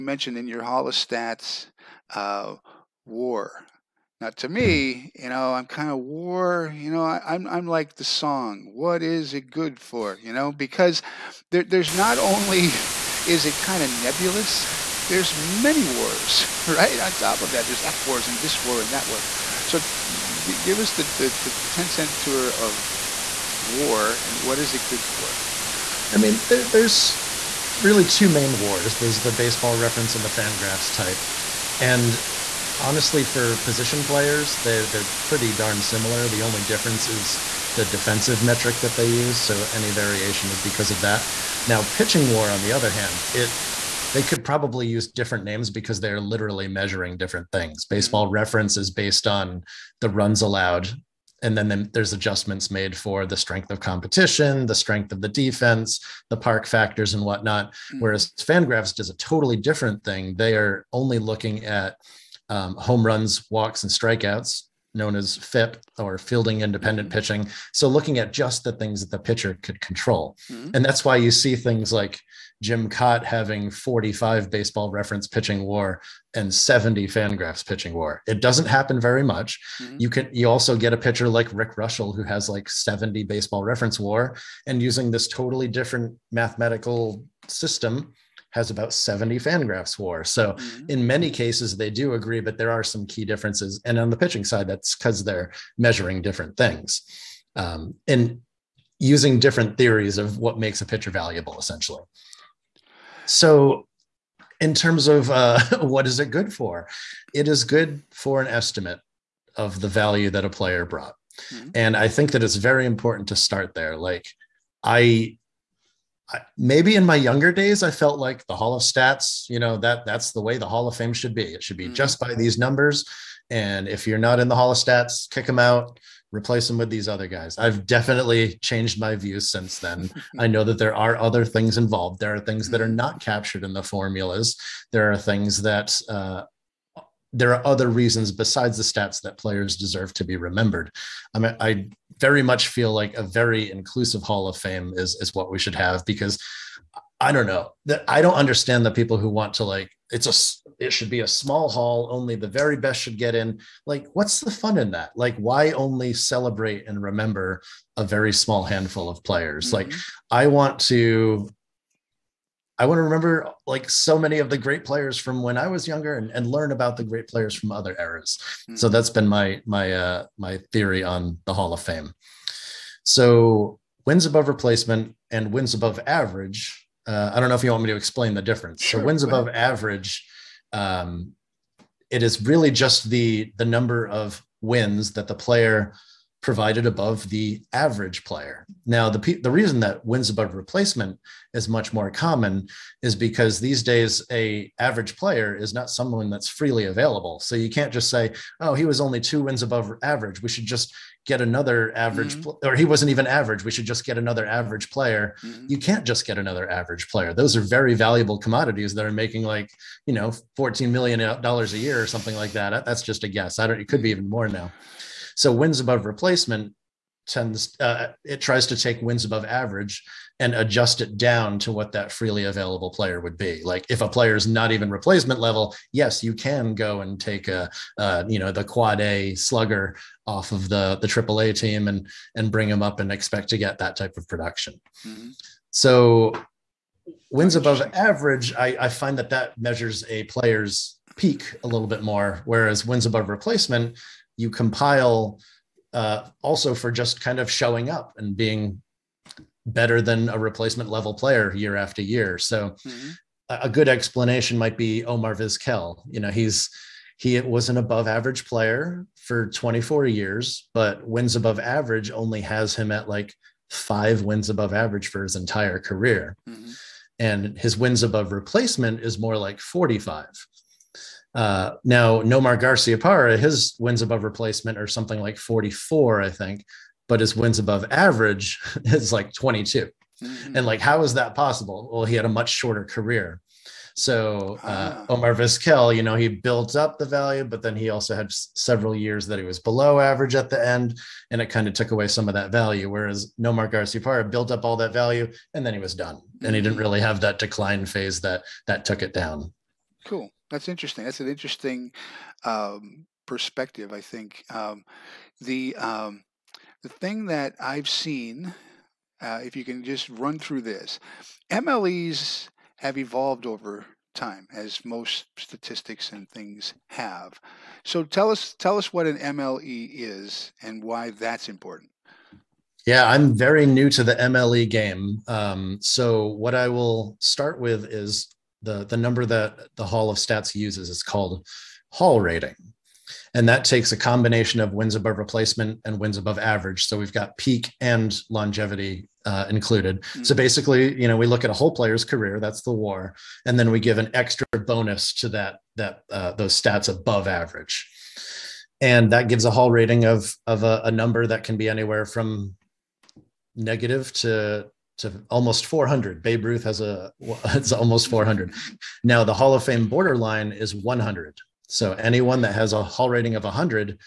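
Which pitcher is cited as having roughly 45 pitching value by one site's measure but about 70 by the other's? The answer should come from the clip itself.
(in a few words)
Jim Kaat.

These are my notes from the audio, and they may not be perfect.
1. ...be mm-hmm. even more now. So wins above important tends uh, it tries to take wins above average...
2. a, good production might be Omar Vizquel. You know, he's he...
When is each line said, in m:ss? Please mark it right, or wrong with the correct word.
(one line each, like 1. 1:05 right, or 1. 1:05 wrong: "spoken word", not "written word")
1. 3:34 wrong: "replacement", not "important"
2. 4:13 wrong: "explanation", not "production".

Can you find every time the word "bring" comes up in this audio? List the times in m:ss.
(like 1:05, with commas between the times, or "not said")
3:52.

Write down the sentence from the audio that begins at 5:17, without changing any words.
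So tell us tell us what an MLE is and why that's important.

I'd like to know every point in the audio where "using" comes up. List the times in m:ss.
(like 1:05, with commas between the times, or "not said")
1:24, 1:38.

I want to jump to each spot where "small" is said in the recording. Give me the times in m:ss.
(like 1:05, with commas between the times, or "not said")
2:31, 2:38.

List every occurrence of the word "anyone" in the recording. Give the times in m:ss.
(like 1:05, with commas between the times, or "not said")
6:01.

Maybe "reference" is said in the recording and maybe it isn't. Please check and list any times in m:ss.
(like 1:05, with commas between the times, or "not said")
0:29, 0:48, 1:14, 1:23.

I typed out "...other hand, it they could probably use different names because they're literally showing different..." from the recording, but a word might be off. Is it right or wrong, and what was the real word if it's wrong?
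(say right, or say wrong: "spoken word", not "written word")
wrong: "measuring", not "showing".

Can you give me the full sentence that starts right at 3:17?
So you can't just say, oh, he was only two wins above average.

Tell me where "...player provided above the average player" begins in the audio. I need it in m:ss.
3:05.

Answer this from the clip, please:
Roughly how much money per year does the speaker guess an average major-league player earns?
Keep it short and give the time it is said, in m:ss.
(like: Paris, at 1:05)
$14 million, at 3:30.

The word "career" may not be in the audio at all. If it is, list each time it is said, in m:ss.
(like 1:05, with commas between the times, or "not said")
4:25, 4:42, 5:42.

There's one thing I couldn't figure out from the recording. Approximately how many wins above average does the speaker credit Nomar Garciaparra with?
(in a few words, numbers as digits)
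22.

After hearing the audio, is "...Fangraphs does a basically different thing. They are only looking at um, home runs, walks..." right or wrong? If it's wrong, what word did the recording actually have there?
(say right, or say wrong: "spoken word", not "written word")
wrong: "totally", not "basically".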